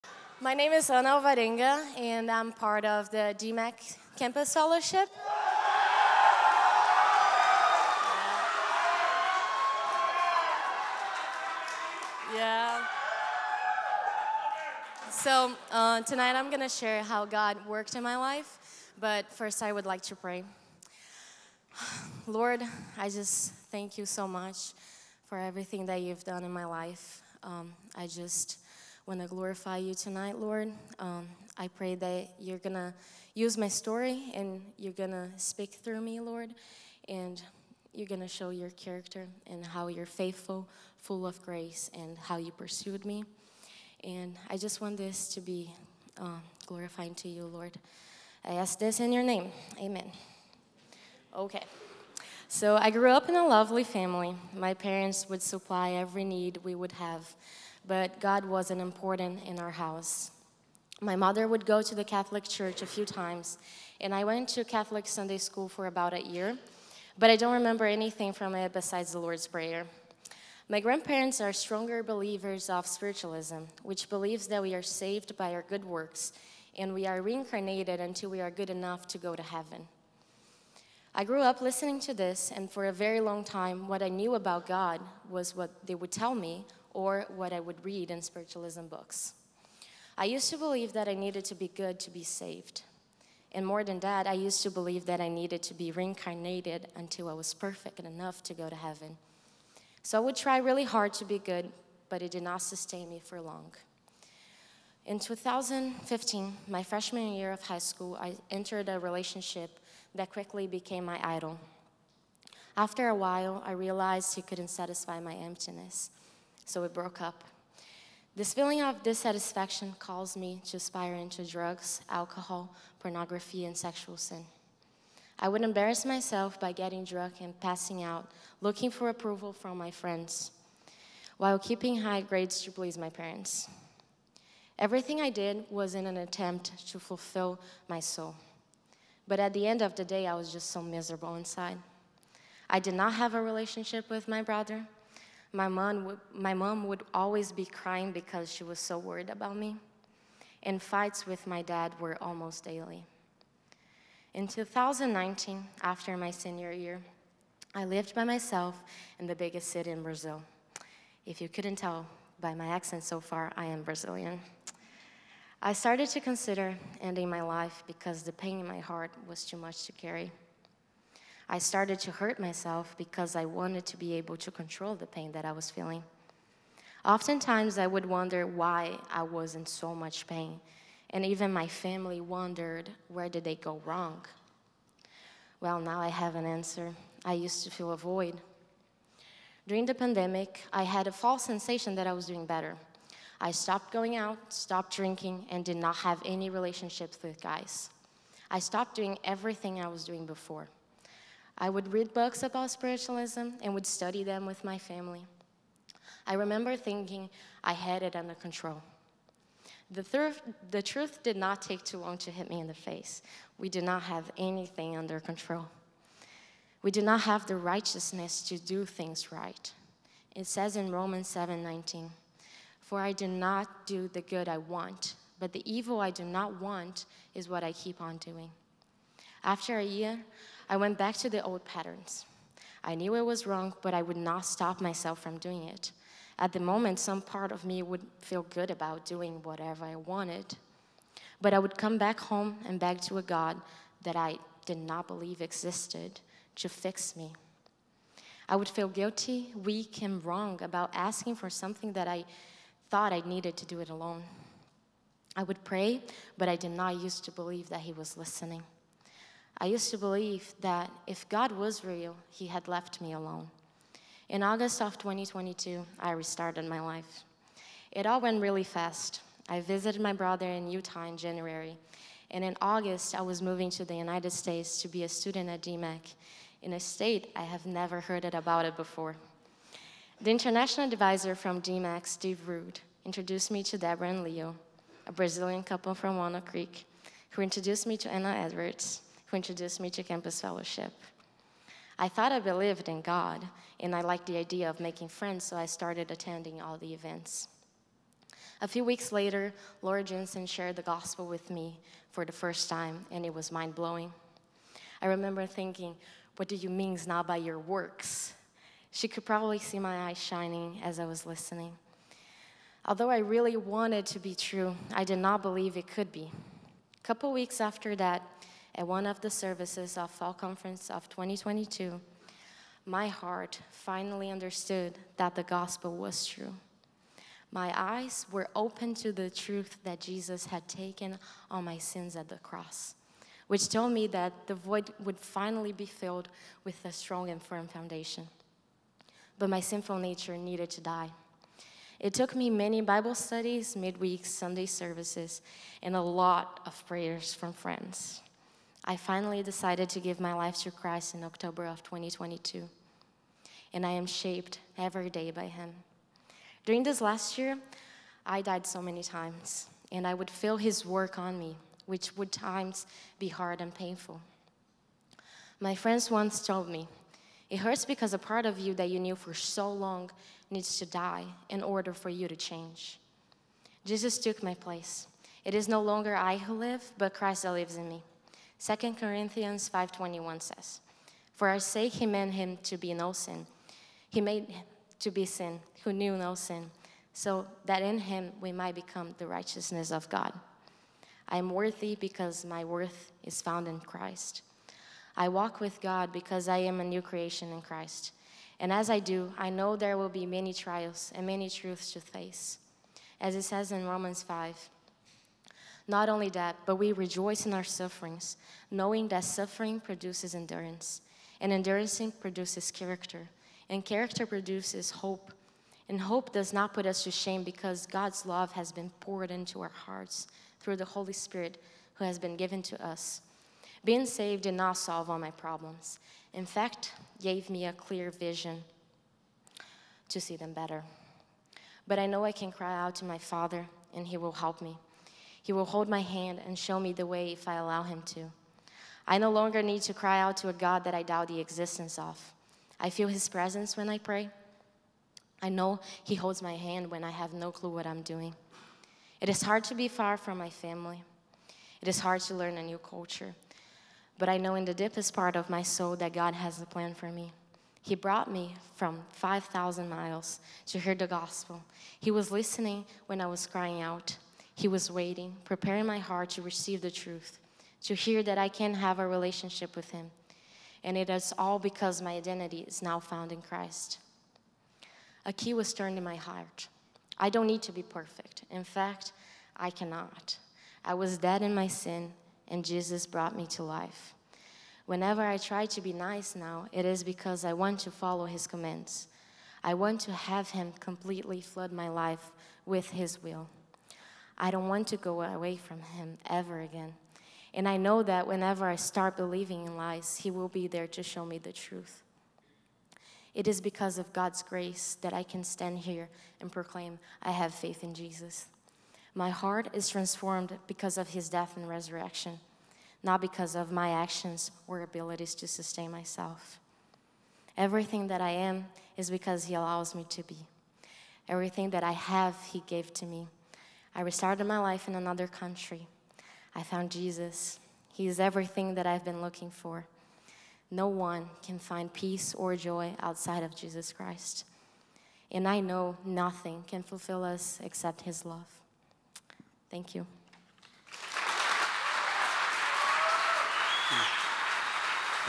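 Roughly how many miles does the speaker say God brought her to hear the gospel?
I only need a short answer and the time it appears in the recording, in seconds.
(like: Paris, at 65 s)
5,000, at 459 s.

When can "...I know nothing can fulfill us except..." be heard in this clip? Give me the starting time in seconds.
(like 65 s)
535 s.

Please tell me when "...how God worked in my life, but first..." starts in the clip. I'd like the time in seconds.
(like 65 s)
17 s.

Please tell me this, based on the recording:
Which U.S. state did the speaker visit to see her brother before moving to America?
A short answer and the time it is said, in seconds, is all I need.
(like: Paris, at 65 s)
Utah, at 270 s.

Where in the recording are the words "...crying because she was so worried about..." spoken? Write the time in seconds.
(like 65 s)
147 s.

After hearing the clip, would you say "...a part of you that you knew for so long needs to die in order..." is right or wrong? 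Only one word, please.
right.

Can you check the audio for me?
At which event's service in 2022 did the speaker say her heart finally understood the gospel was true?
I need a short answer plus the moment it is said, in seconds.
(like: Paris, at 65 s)
Fall Conference, at 320 s.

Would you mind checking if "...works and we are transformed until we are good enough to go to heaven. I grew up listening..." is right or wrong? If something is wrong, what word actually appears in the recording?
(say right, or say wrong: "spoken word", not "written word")
wrong: "reincarnated", not "transformed".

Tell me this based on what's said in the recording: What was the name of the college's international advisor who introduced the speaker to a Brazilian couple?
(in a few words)
Steve Rude.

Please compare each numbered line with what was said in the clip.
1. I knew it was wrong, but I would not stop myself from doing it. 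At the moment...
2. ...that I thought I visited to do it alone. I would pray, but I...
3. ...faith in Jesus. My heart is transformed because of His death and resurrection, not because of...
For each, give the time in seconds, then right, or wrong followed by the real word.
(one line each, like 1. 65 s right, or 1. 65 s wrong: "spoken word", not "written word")
1. 232 s right
2. 251 s wrong: "needed", not "visited"
3. 507 s right.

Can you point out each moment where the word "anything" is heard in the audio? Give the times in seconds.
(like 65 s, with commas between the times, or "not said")
67 s, 214 s.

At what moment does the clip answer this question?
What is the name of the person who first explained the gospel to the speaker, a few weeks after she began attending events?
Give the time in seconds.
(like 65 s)
299 s.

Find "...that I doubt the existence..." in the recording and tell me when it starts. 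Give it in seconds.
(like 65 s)
440 s.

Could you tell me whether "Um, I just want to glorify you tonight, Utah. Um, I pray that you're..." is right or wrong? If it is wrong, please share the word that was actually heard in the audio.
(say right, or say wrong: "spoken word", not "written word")
wrong: "Lord", not "Utah".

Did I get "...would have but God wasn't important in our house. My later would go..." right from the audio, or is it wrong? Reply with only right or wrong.
wrong.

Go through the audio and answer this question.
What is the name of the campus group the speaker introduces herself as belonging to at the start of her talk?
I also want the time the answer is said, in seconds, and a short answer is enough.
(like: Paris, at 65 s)
DMACC Campus Fellowship, at 3 s.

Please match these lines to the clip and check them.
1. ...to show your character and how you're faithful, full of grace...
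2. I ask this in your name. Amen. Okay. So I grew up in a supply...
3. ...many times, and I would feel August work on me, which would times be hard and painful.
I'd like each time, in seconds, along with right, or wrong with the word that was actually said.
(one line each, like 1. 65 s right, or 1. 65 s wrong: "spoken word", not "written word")
1. 38 s right
2. 48 s wrong: "lovely", not "supply"
3. 358 s wrong: "His", not "August".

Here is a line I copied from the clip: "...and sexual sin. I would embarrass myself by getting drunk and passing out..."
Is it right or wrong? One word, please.
right.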